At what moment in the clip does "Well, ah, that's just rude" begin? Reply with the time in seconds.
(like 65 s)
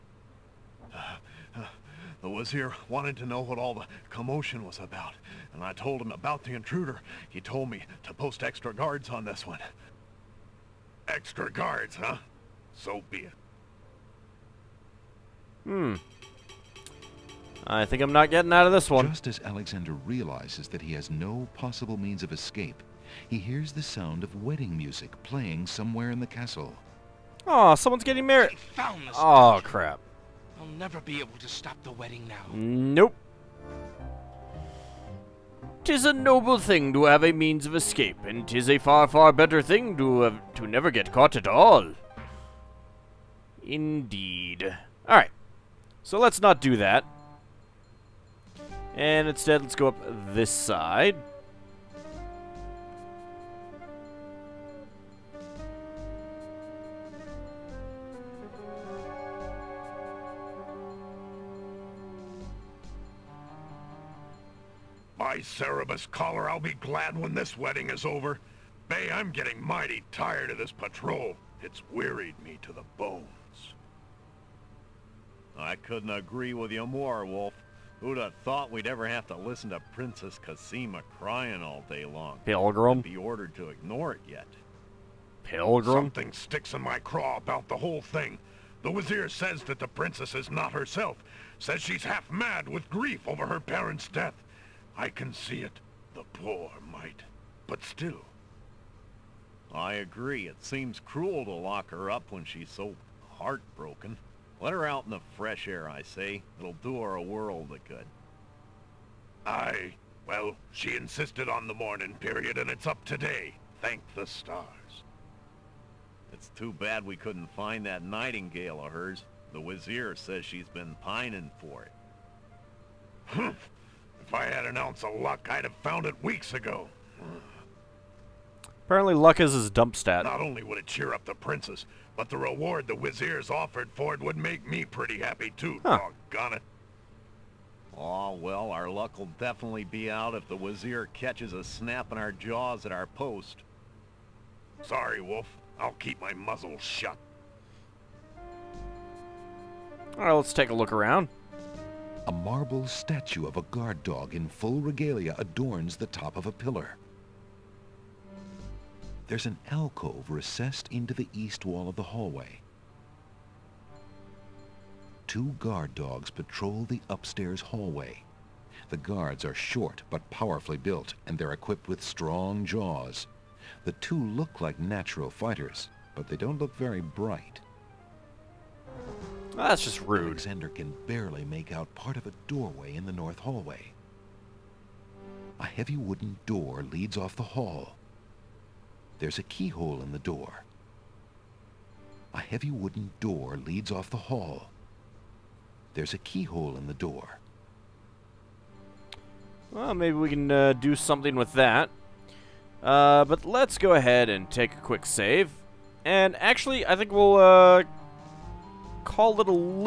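179 s.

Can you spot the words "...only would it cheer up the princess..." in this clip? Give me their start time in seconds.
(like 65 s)
130 s.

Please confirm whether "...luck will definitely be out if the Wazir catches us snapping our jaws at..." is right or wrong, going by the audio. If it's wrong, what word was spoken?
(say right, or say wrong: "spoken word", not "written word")
right.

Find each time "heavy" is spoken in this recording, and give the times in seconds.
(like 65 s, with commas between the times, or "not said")
185 s, 192 s.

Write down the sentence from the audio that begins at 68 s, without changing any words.
Bay, I'm getting mighty tired of this patrol.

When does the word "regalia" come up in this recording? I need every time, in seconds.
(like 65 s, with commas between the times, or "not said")
154 s.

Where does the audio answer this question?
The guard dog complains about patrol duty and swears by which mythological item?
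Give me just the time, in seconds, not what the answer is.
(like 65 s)
65 s.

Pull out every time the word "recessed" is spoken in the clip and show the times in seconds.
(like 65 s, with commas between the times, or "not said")
160 s.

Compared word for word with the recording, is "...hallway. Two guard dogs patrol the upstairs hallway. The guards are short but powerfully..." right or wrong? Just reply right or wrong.
right.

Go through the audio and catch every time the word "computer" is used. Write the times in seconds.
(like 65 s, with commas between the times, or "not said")
not said.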